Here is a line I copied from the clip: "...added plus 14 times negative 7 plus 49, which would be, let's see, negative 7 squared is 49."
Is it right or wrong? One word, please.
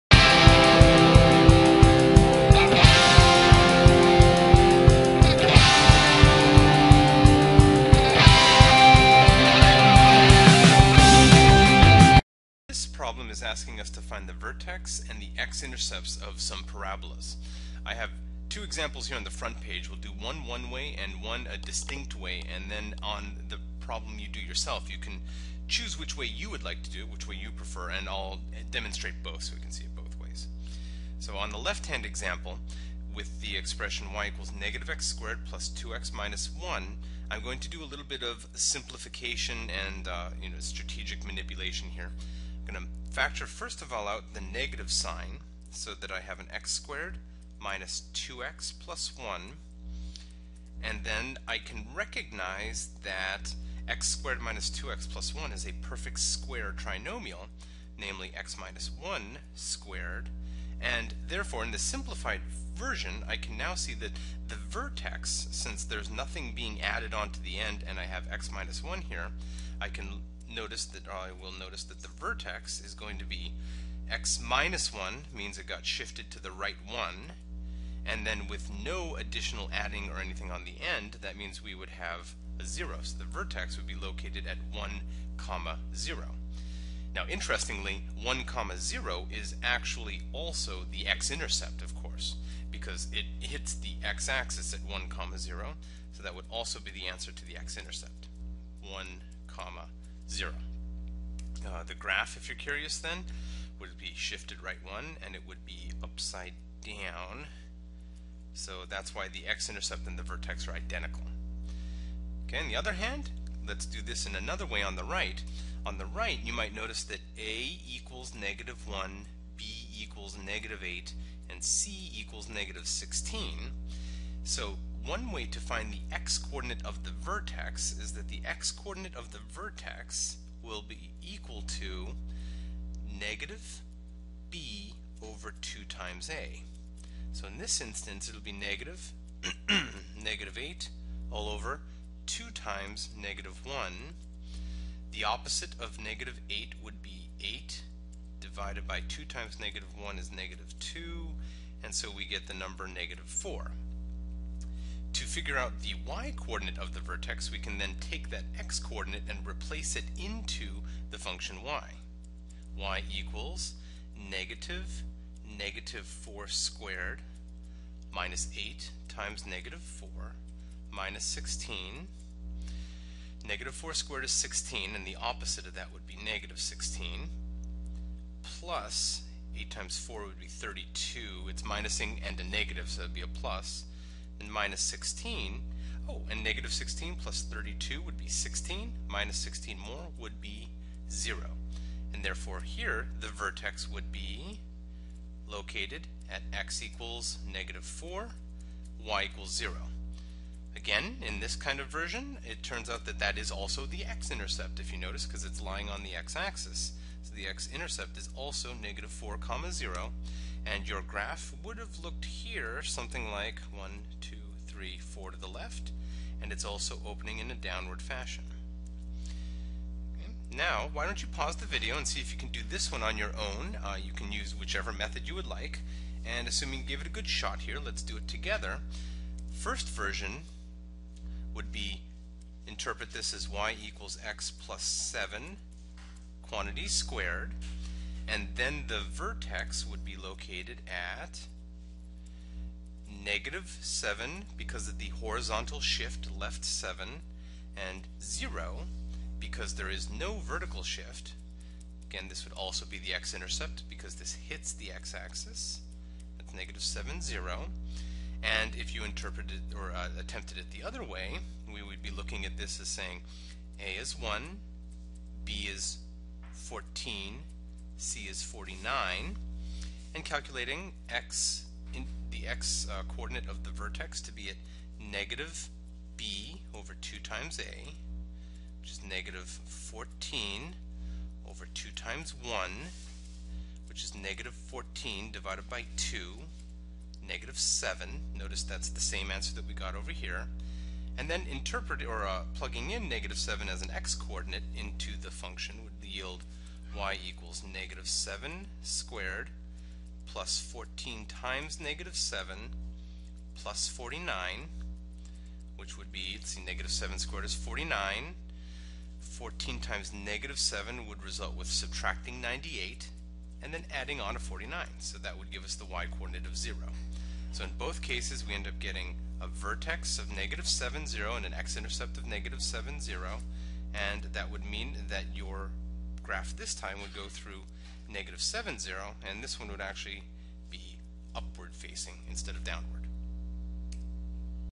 wrong.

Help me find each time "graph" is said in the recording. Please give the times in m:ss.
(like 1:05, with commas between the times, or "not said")
1:41, 3:31, 5:26.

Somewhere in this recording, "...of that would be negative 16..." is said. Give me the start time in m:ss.
2:55.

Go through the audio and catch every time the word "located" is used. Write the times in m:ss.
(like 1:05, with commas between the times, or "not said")
1:23, 3:15, 4:00.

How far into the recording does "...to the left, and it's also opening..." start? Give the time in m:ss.
3:35.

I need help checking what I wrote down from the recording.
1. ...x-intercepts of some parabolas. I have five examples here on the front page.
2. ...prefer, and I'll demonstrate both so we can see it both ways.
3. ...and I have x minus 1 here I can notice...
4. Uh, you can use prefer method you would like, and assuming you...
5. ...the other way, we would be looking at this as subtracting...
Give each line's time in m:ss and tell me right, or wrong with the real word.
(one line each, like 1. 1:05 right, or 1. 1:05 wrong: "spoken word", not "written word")
1. 0:15 wrong: "two", not "five"
2. 0:27 right
3. 1:07 right
4. 3:43 wrong: "whichever", not "prefer"
5. 4:20 wrong: "saying", not "subtracting".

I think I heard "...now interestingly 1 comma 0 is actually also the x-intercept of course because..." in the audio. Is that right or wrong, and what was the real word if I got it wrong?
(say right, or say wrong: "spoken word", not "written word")
right.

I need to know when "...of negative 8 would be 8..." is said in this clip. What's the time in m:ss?
2:25.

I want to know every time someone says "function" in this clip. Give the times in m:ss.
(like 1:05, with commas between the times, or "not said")
2:41, 4:55.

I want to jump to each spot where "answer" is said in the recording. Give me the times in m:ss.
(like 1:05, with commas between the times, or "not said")
1:37, 4:49.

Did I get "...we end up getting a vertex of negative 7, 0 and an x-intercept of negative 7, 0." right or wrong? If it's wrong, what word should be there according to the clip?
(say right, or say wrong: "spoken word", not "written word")
right.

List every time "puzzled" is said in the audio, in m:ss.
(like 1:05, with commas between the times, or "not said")
not said.